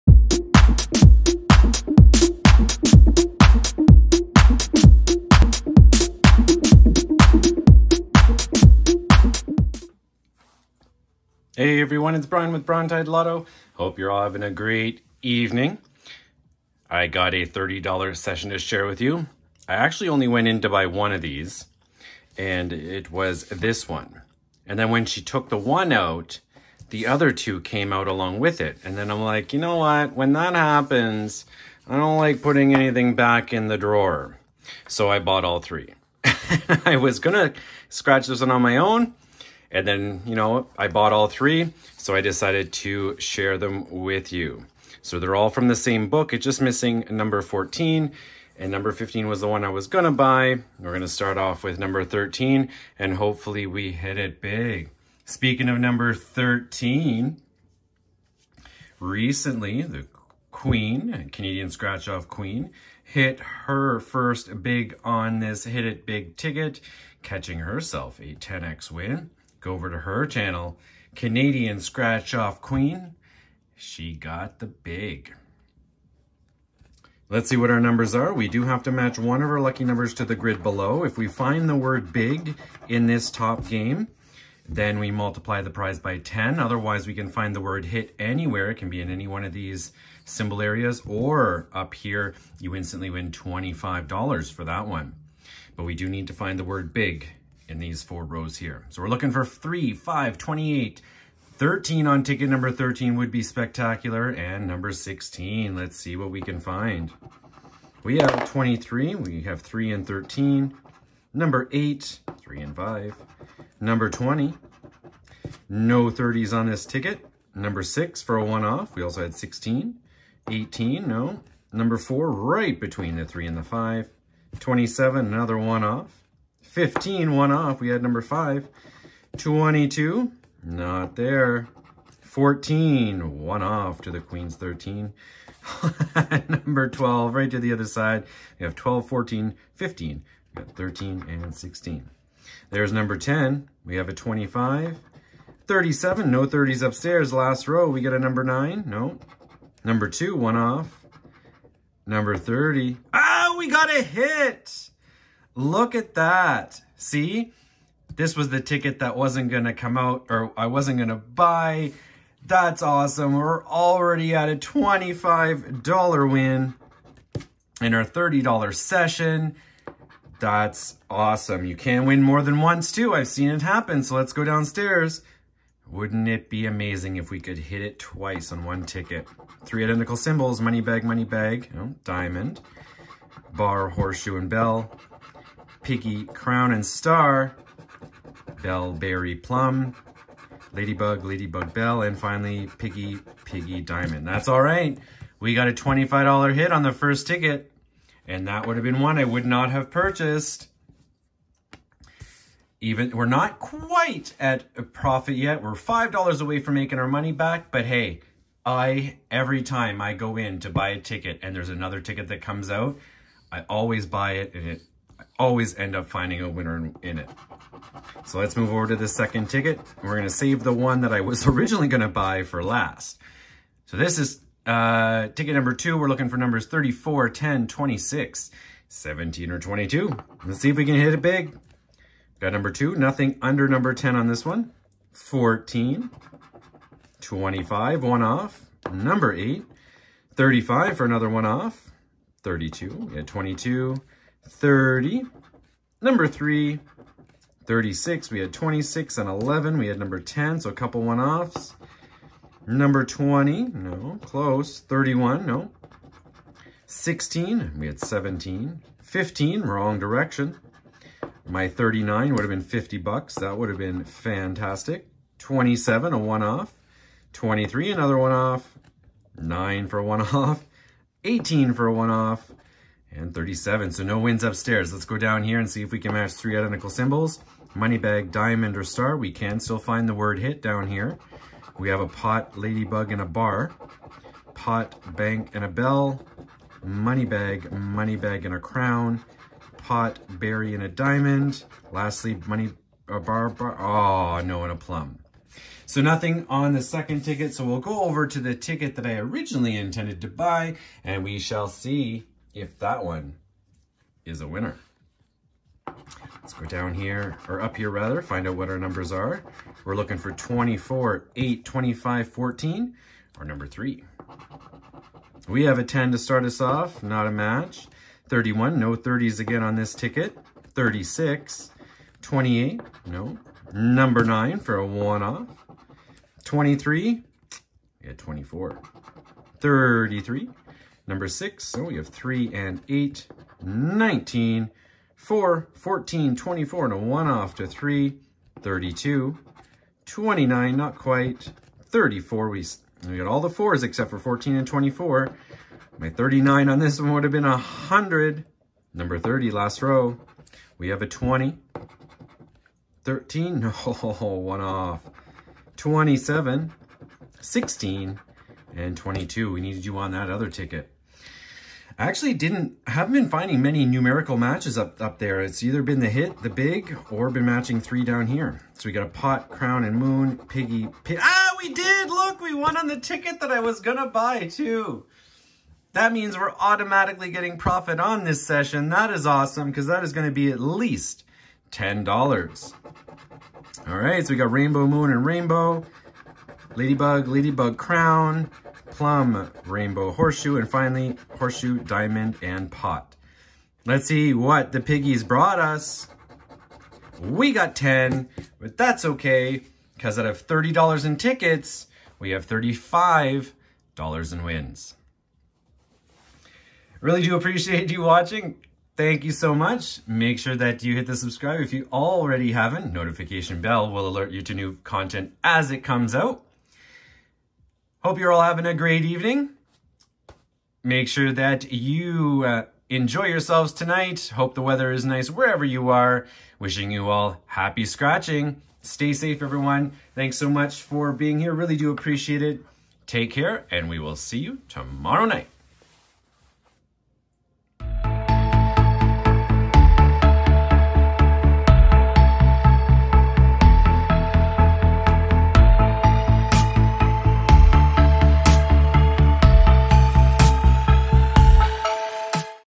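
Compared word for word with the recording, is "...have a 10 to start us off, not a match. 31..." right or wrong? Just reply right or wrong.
right.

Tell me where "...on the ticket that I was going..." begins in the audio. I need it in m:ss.
6:12.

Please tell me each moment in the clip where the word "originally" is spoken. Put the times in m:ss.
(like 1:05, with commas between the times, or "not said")
3:41, 4:59.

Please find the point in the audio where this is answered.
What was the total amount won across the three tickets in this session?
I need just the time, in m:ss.
6:42.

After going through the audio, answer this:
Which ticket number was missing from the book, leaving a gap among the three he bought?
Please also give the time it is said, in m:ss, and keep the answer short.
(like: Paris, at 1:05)
14, at 0:46.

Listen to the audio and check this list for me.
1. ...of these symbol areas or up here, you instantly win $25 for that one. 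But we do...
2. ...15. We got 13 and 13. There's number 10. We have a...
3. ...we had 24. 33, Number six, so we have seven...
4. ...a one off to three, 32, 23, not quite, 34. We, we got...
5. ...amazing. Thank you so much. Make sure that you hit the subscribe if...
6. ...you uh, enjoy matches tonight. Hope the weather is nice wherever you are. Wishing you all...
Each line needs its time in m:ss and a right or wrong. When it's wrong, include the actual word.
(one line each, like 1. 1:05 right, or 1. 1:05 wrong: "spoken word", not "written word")
1. 1:29 right
2. 2:19 wrong: "16", not "13"
3. 5:28 wrong: "three", not "seven"
4. 5:36 wrong: "29", not "23"
5. 6:48 wrong: "watching", not "amazing"
6. 7:01 wrong: "yourselves", not "matches".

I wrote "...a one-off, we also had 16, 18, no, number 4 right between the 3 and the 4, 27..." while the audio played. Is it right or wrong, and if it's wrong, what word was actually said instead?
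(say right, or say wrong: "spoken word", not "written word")
wrong: "5", not "4".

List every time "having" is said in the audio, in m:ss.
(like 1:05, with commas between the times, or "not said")
0:14, 6:58.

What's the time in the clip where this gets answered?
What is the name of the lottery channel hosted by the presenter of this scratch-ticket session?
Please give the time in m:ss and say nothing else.
0:12.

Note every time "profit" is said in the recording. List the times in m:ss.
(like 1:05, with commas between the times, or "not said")
3:24, 6:17.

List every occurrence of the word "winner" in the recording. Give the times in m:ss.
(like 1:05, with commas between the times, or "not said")
3:36, 5:04.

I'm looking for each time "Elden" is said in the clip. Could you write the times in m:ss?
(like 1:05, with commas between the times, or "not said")
not said.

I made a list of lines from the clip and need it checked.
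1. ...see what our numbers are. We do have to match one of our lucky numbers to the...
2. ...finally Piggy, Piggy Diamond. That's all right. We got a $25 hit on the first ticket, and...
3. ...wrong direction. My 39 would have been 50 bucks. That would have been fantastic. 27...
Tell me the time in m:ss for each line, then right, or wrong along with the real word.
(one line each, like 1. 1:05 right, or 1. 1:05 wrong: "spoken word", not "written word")
1. 1:17 right
2. 3:12 right
3. 4:19 right.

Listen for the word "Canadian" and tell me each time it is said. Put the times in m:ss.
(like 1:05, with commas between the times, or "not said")
1:01, 1:11.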